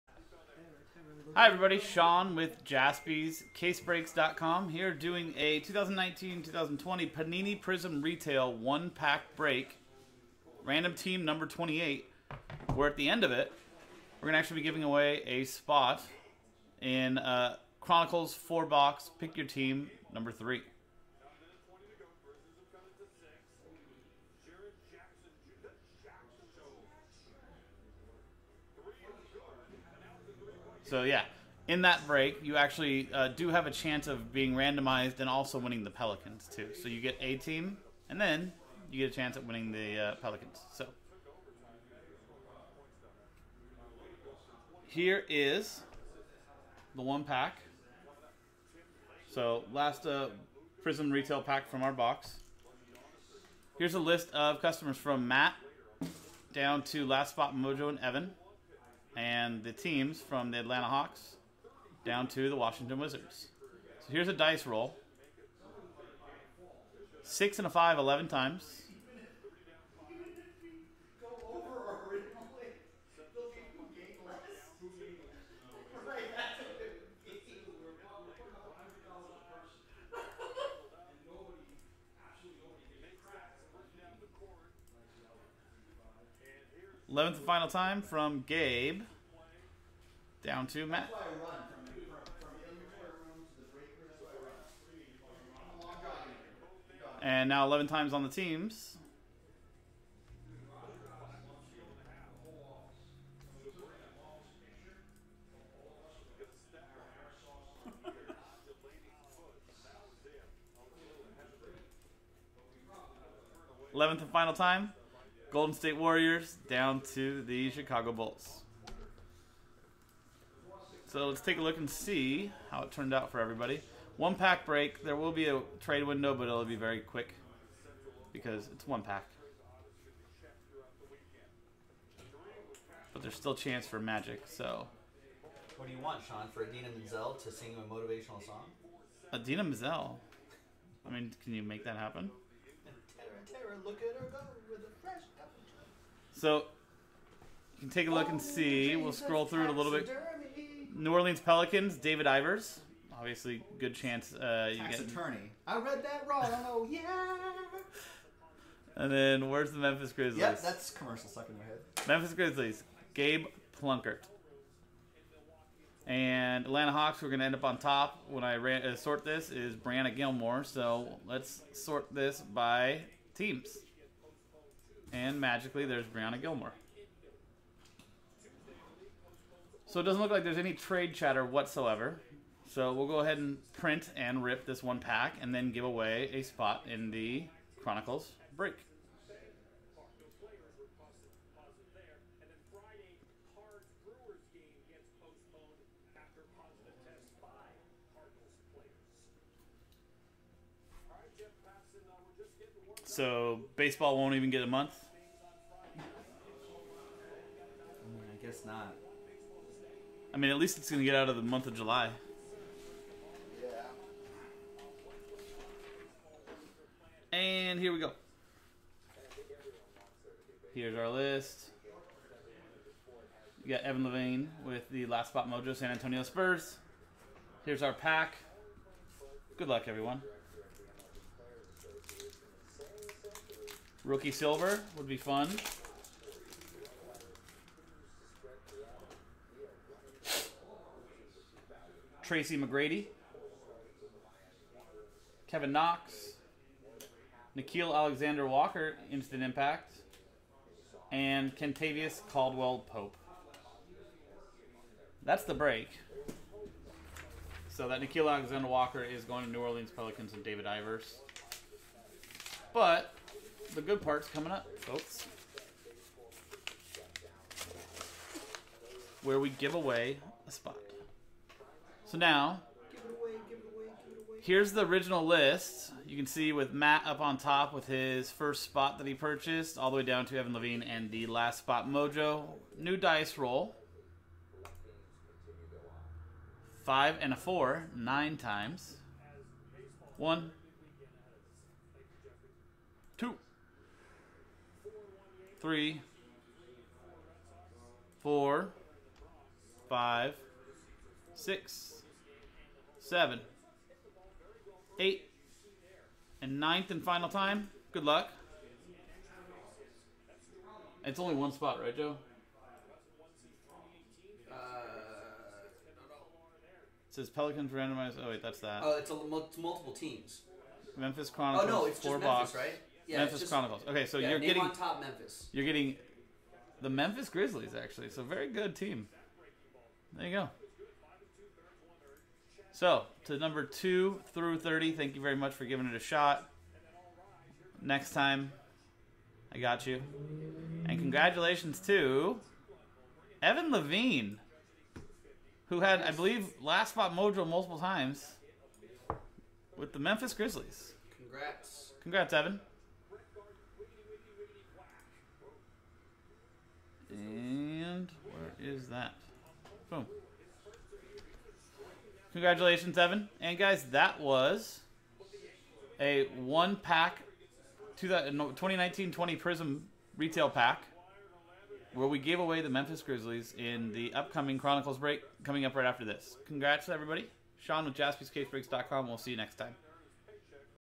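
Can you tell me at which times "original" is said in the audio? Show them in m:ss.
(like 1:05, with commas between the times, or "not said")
4:34.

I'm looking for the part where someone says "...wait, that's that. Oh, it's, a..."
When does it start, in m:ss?
5:18.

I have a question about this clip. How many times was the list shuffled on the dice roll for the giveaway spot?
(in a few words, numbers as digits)
9.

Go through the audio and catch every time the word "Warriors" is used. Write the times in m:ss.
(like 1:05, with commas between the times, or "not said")
1:55.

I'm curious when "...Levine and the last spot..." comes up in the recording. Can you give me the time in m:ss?
4:40.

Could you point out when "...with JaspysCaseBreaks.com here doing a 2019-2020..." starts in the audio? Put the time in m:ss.
0:02.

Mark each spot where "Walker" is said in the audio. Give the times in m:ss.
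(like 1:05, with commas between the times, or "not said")
4:08, 4:18.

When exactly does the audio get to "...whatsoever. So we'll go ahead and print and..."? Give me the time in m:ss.
3:01.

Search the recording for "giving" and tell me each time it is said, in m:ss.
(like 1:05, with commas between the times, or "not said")
0:14, 5:35.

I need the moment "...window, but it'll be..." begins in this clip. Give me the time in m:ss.
2:06.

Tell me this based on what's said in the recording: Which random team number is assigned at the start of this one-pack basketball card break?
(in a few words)
28.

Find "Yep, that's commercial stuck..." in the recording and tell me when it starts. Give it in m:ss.
2:40.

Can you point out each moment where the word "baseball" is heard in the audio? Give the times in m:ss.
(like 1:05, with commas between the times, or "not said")
3:23.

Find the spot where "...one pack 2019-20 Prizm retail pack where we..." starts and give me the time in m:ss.
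6:06.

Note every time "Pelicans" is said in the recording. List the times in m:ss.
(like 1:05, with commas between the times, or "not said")
0:35, 0:40, 2:31, 4:19, 5:17.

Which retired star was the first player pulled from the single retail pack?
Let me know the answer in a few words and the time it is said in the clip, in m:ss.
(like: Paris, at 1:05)
Tracy McGrady, at 4:02.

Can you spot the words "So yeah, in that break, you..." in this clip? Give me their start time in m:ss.
0:30.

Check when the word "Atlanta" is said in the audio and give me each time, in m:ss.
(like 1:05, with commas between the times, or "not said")
1:00, 2:46.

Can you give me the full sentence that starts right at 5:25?
You're getting the Memphis Grizzlies actually.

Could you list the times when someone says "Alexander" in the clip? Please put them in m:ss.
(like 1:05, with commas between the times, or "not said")
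4:07, 4:18.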